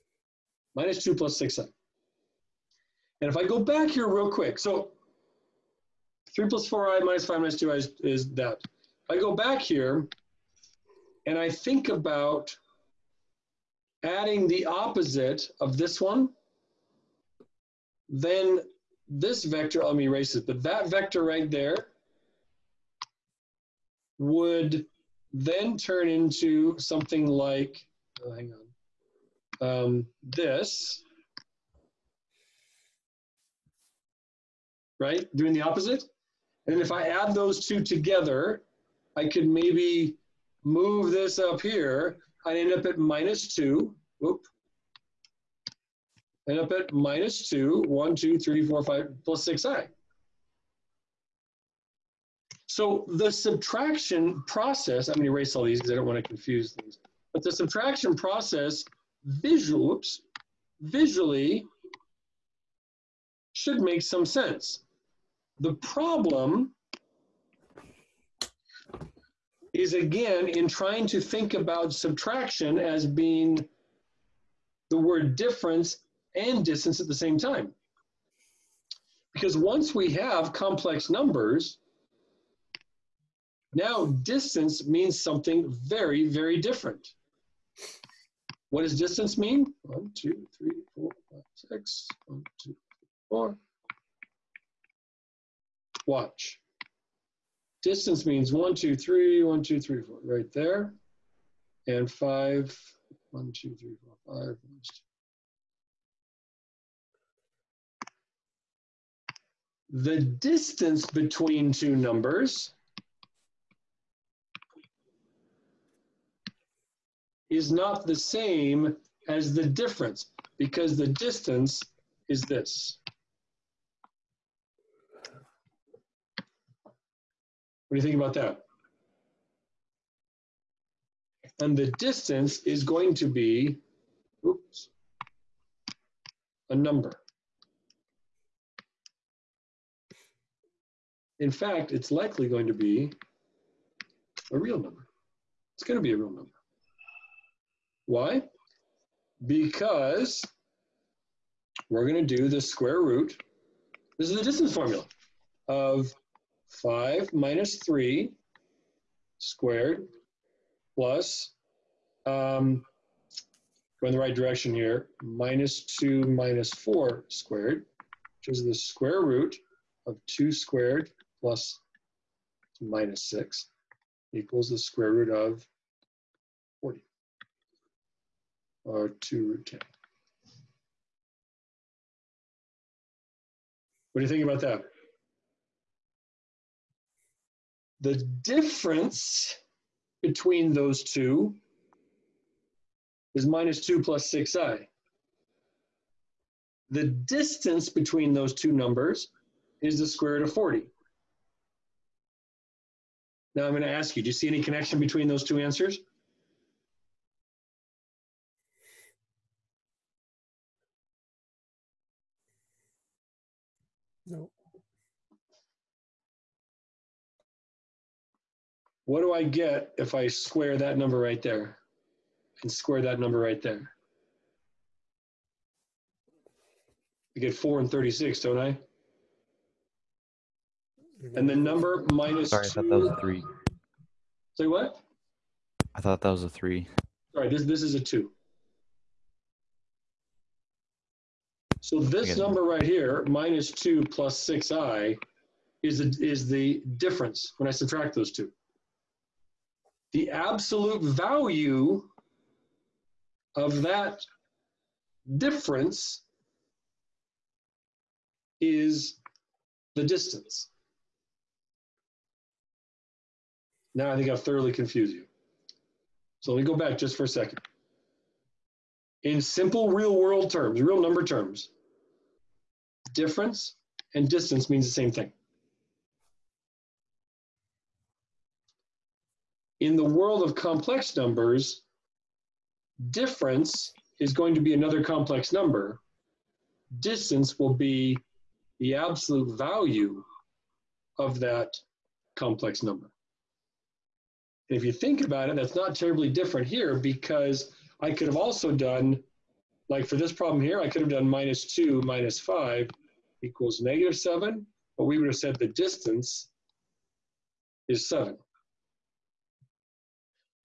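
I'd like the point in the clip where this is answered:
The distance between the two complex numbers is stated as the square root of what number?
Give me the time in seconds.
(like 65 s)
199 s.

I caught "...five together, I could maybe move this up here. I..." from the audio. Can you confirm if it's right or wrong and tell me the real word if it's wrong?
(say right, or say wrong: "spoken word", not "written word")
wrong: "two", not "five".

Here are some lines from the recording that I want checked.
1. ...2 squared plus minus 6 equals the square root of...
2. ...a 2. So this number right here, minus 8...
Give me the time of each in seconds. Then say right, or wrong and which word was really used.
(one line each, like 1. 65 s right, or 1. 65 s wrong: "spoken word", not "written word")
1. 170 s right
2. 237 s wrong: "2", not "8".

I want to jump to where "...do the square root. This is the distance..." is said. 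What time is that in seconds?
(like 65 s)
152 s.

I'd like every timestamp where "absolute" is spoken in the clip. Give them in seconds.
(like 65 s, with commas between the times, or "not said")
250 s, 288 s.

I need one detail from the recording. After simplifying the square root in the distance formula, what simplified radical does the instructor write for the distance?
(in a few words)
2√10.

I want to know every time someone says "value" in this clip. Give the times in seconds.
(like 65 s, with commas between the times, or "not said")
251 s, 289 s.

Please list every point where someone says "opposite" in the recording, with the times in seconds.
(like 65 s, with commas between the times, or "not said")
14 s, 35 s.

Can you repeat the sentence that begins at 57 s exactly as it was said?
But the subtraction process visual, oops, visually should make some sense.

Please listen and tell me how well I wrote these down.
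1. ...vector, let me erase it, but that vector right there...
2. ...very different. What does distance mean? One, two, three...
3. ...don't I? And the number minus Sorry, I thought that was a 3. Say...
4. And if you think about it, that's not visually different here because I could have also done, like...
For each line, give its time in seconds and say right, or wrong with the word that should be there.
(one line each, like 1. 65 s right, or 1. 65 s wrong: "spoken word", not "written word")
1. 19 s right
2. 86 s right
3. 228 s right
4. 294 s wrong: "terribly", not "visually".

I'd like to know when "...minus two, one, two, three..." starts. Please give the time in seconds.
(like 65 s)
46 s.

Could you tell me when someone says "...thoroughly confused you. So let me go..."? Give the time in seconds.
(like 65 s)
264 s.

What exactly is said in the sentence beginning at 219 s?
What do I get if I square that number right there?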